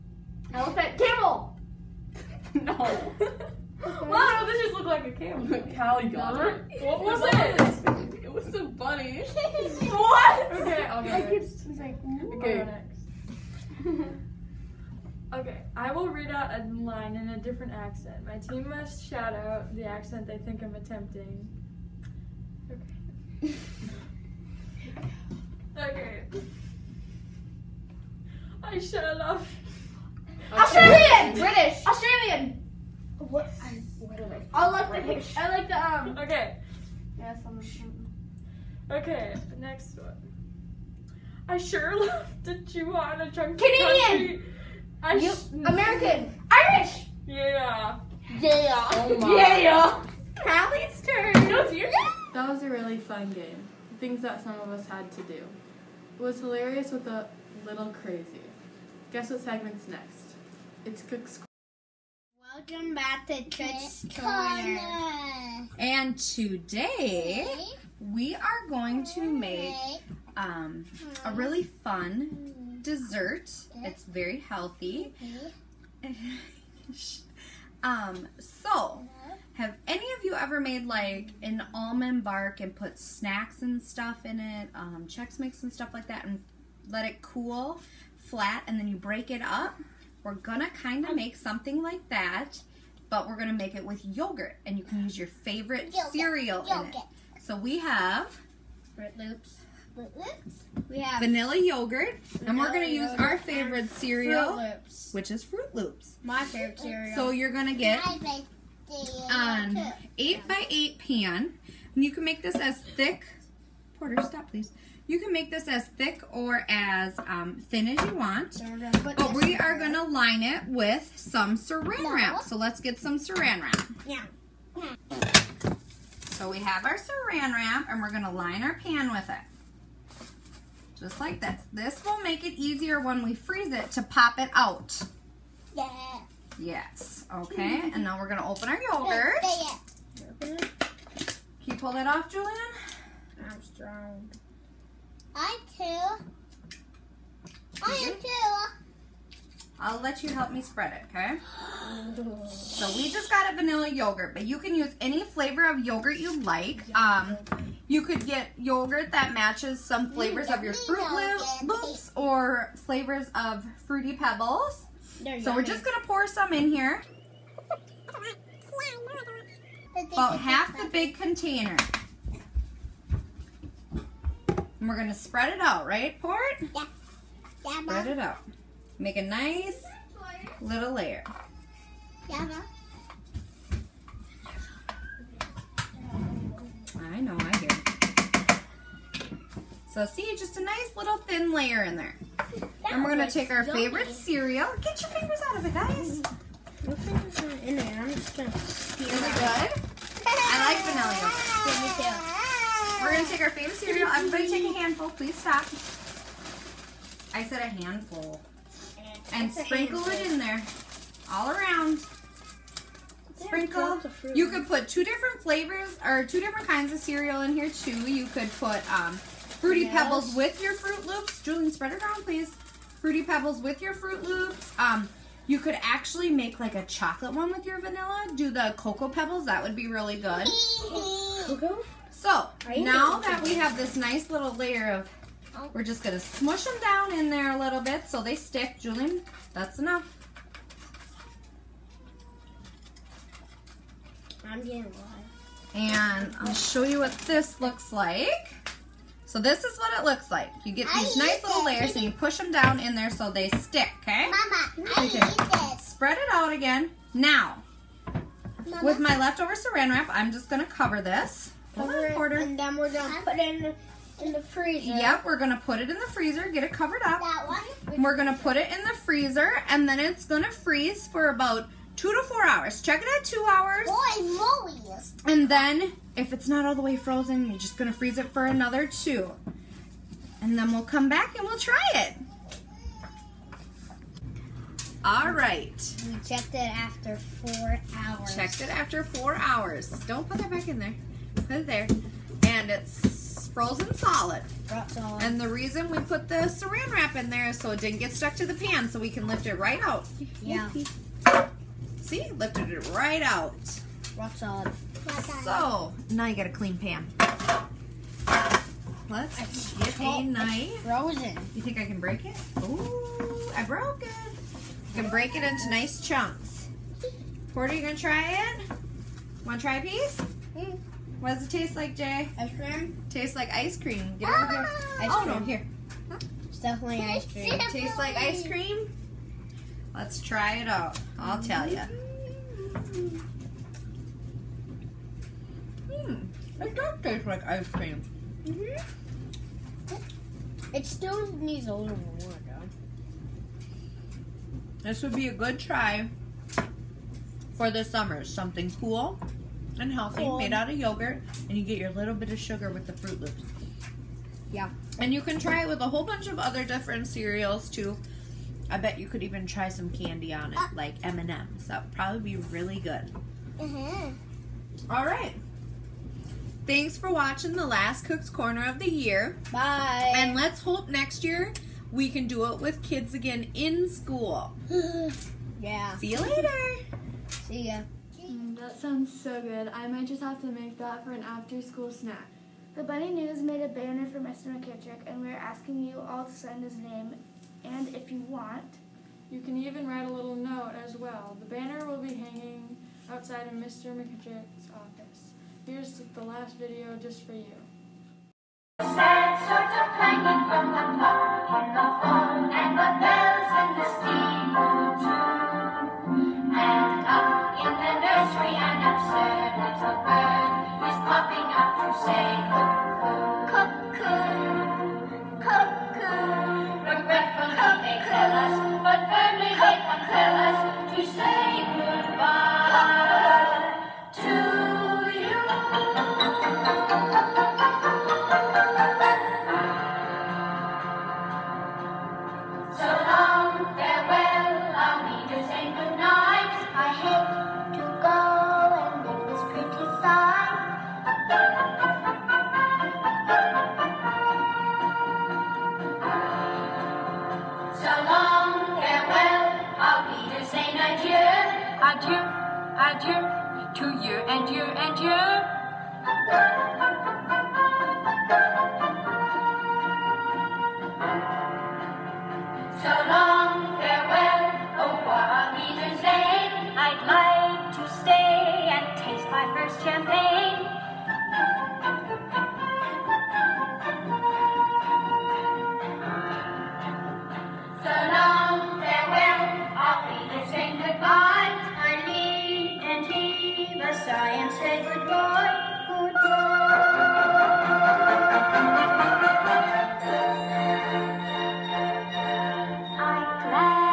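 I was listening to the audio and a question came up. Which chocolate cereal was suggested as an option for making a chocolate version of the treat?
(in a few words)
Cocoa Pebbles.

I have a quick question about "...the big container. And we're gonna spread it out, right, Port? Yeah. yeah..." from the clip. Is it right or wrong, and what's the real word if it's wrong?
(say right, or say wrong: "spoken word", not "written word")
right.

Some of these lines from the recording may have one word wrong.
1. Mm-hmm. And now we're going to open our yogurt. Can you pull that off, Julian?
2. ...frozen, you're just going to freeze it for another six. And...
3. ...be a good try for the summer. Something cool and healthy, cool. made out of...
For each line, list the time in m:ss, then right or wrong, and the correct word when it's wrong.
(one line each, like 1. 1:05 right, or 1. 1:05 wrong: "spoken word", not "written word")
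1. 2:17 right
2. 4:36 wrong: "two", not "six"
3. 5:45 right.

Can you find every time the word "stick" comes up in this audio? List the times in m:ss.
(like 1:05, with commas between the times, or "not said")
3:58, 4:13.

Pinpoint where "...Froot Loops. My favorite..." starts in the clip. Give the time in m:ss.
1:45.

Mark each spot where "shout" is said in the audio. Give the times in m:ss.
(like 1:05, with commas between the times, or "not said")
0:19.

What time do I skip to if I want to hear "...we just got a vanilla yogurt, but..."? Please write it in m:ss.
2:32.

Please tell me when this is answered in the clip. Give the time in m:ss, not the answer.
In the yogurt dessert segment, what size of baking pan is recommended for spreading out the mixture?
1:50.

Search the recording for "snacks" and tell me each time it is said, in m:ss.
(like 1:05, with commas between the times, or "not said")
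1:22, 6:21.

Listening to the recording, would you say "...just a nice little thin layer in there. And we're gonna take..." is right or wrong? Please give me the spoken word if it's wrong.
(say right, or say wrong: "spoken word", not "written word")
right.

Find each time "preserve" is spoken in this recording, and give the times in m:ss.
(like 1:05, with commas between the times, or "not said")
not said.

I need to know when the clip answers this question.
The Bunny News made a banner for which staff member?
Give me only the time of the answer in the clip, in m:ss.
6:24.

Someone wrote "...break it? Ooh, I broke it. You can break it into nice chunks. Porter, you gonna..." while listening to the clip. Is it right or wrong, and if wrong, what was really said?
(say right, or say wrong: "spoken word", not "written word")
right.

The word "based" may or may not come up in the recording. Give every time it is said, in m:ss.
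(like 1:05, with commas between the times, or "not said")
not said.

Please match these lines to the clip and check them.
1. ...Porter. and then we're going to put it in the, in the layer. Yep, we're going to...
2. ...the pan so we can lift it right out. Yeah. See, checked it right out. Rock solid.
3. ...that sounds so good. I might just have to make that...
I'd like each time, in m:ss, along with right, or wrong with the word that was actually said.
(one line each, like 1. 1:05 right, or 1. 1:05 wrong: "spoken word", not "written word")
1. 4:22 wrong: "freezer", not "layer"
2. 4:58 wrong: "lifted", not "checked"
3. 6:18 right.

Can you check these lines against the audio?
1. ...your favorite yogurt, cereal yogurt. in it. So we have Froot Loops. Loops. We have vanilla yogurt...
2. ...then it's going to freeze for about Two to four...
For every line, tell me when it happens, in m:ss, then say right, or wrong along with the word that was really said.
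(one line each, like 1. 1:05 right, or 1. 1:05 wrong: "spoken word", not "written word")
1. 1:35 right
2. 4:29 right.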